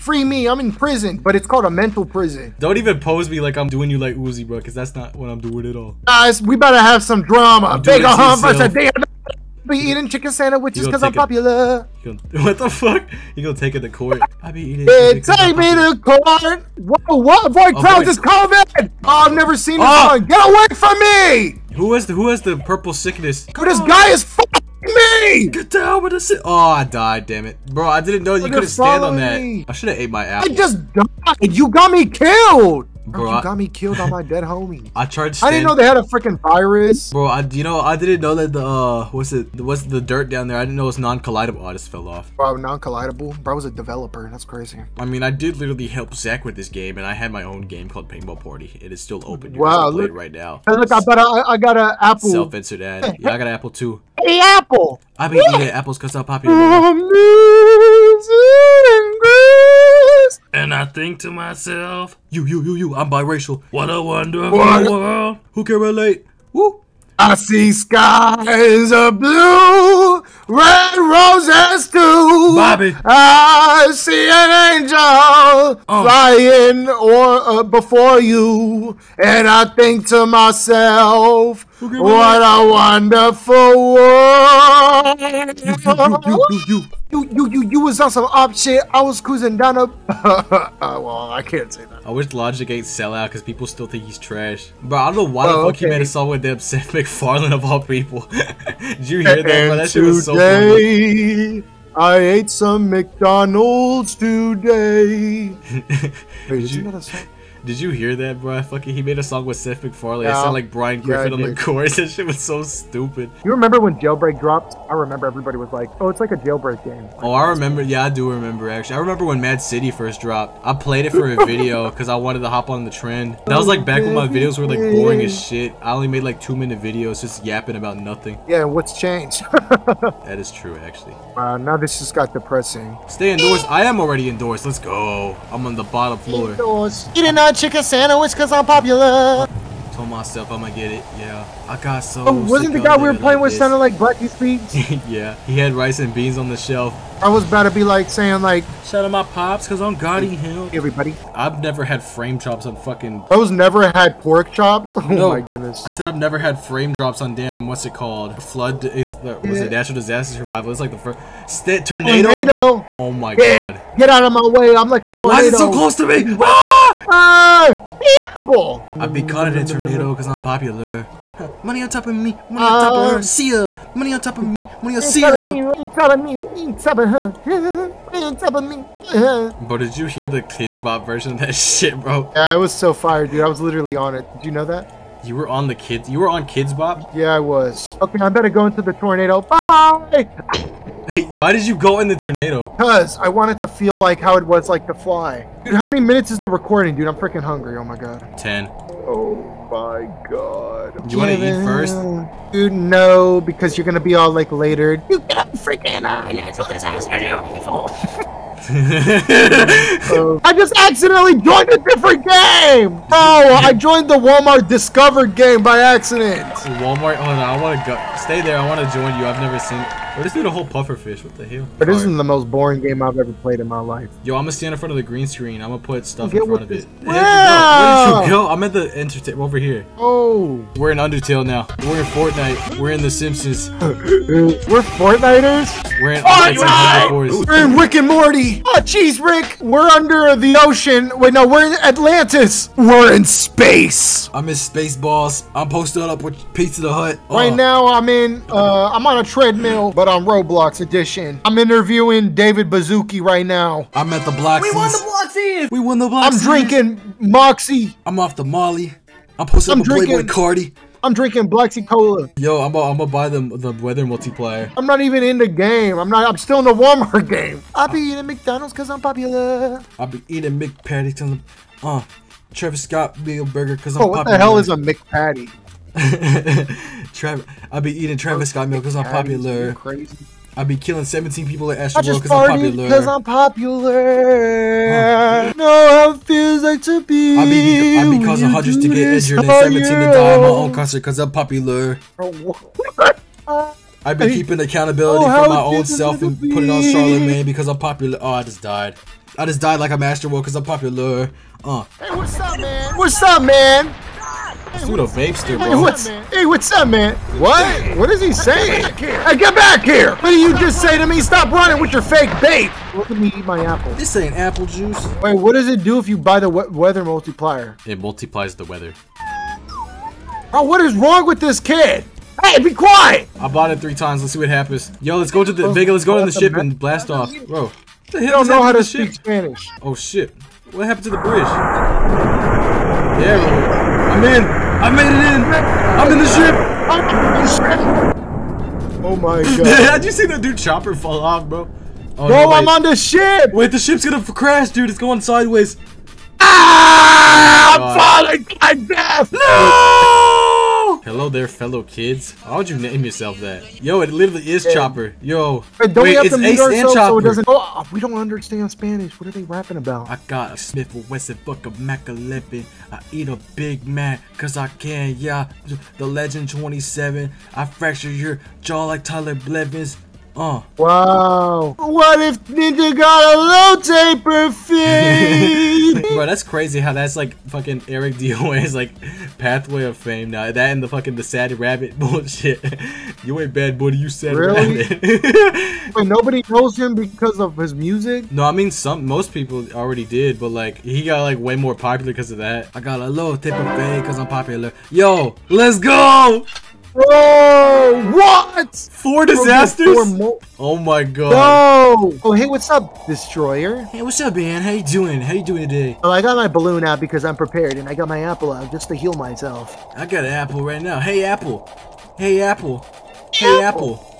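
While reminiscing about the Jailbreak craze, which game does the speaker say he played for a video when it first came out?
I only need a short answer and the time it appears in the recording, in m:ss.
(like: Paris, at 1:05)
Mad City, at 1:59.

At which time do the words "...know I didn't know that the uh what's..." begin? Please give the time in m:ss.
0:37.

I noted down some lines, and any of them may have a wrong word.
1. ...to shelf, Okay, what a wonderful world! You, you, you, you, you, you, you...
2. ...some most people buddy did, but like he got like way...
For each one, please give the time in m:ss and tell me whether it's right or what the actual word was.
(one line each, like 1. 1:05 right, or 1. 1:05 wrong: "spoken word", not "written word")
1. 1:20 wrong: "myself", not "shelf"
2. 6:28 wrong: "already", not "buddy".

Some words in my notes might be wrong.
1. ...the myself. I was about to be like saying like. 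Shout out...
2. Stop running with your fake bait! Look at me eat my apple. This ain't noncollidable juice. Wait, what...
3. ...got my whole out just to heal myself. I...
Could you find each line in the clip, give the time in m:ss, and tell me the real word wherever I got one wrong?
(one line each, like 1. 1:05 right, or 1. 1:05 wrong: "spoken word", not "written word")
1. 2:26 wrong: "shelf", not "myself"
2. 5:11 wrong: "apple", not "noncollidable"
3. 6:47 wrong: "apple", not "whole".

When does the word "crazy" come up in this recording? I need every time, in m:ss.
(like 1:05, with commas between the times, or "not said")
0:44, 6:16.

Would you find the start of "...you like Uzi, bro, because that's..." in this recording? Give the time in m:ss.
0:03.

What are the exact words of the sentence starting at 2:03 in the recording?
That was like back when my videos were like boring as shit.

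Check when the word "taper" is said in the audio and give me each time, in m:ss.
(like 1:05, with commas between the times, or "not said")
6:14, 6:33.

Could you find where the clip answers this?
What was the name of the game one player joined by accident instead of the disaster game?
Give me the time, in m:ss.
3:34.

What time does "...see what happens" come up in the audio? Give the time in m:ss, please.
5:24.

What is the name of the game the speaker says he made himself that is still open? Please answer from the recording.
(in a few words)
Paintball Party.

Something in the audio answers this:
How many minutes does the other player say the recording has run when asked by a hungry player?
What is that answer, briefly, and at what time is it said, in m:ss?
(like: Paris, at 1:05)
10, at 3:18.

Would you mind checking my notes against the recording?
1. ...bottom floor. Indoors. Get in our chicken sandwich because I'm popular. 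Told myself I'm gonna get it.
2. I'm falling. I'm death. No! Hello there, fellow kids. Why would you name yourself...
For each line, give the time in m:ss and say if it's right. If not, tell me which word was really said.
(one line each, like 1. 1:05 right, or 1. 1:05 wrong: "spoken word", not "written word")
1. 2:15 right
2. 5:47 right.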